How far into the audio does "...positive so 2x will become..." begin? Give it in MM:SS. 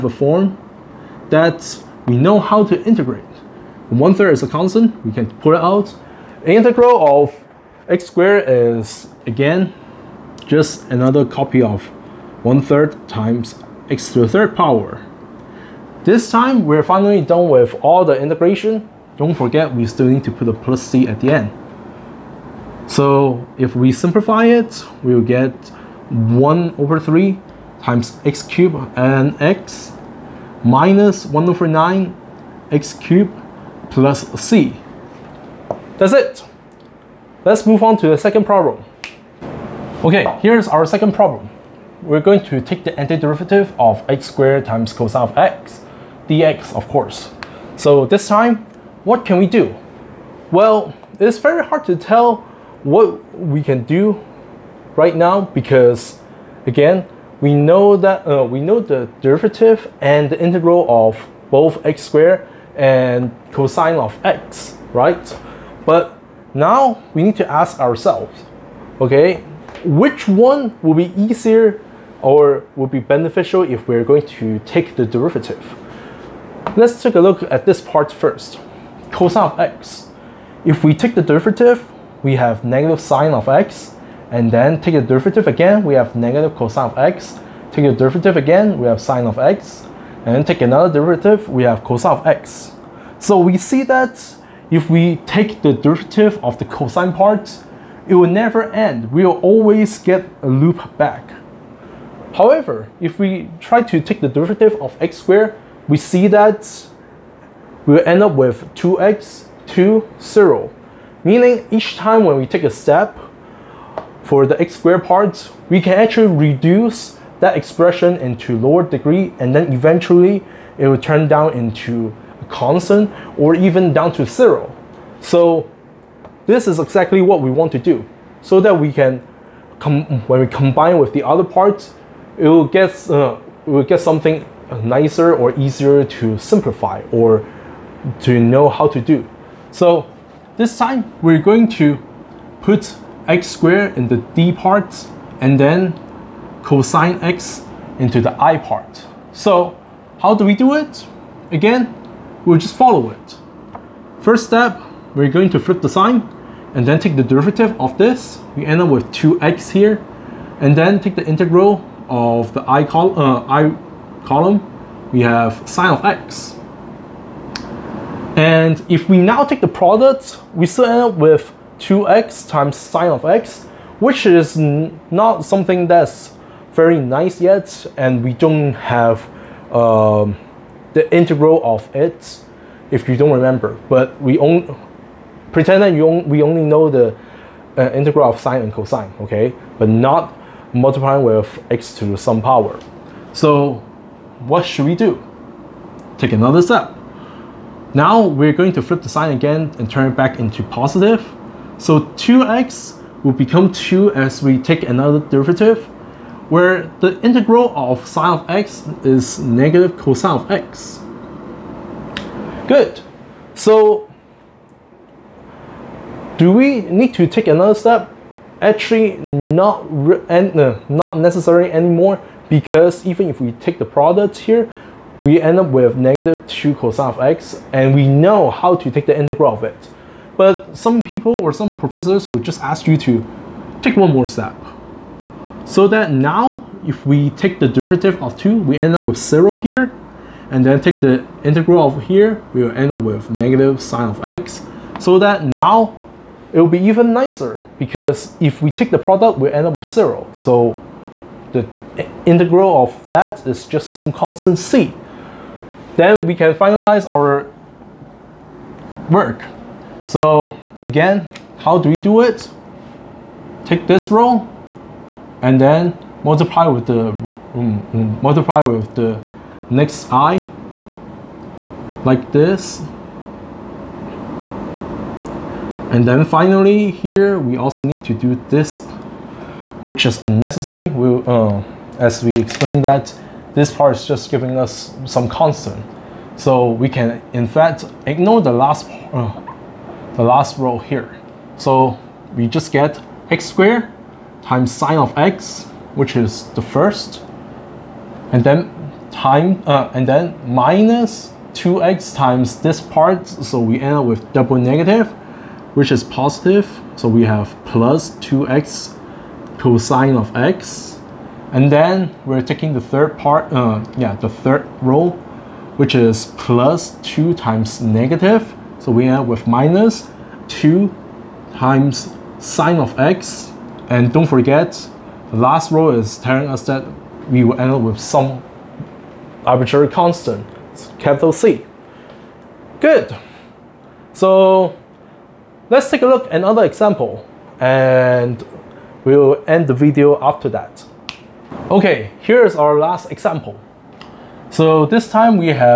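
03:20.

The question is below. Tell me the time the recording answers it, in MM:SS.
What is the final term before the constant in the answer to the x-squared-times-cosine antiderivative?
05:19.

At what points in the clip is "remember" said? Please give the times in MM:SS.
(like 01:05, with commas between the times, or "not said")
03:03.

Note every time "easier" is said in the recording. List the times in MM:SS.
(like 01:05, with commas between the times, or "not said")
01:11, 02:15.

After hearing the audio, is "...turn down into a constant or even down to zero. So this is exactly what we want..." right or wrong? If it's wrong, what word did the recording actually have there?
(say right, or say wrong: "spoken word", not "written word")
right.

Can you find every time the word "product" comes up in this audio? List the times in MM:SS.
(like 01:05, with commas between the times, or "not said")
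02:49, 03:43, 04:08.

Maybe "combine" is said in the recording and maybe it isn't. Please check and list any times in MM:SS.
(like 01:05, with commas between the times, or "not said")
02:10.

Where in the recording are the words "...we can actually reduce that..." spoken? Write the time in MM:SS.
01:55.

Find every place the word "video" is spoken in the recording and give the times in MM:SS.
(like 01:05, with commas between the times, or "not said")
05:39.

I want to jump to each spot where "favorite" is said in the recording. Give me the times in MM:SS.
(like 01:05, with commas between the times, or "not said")
not said.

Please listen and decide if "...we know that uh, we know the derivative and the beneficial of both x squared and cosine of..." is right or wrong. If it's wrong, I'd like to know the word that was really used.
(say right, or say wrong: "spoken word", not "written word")
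wrong: "integral", not "beneficial".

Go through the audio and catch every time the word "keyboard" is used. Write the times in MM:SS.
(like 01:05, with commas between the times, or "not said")
not said.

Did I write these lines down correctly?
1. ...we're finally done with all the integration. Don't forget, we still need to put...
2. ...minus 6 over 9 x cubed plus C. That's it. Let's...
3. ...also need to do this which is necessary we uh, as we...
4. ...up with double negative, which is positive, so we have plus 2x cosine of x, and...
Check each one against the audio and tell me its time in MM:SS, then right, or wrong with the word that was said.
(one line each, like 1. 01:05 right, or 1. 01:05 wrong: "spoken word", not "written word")
1. 00:16 right
2. 00:30 wrong: "1", not "6"
3. 04:37 wrong: "unnecessary", not "necessary"
4. 05:03 right.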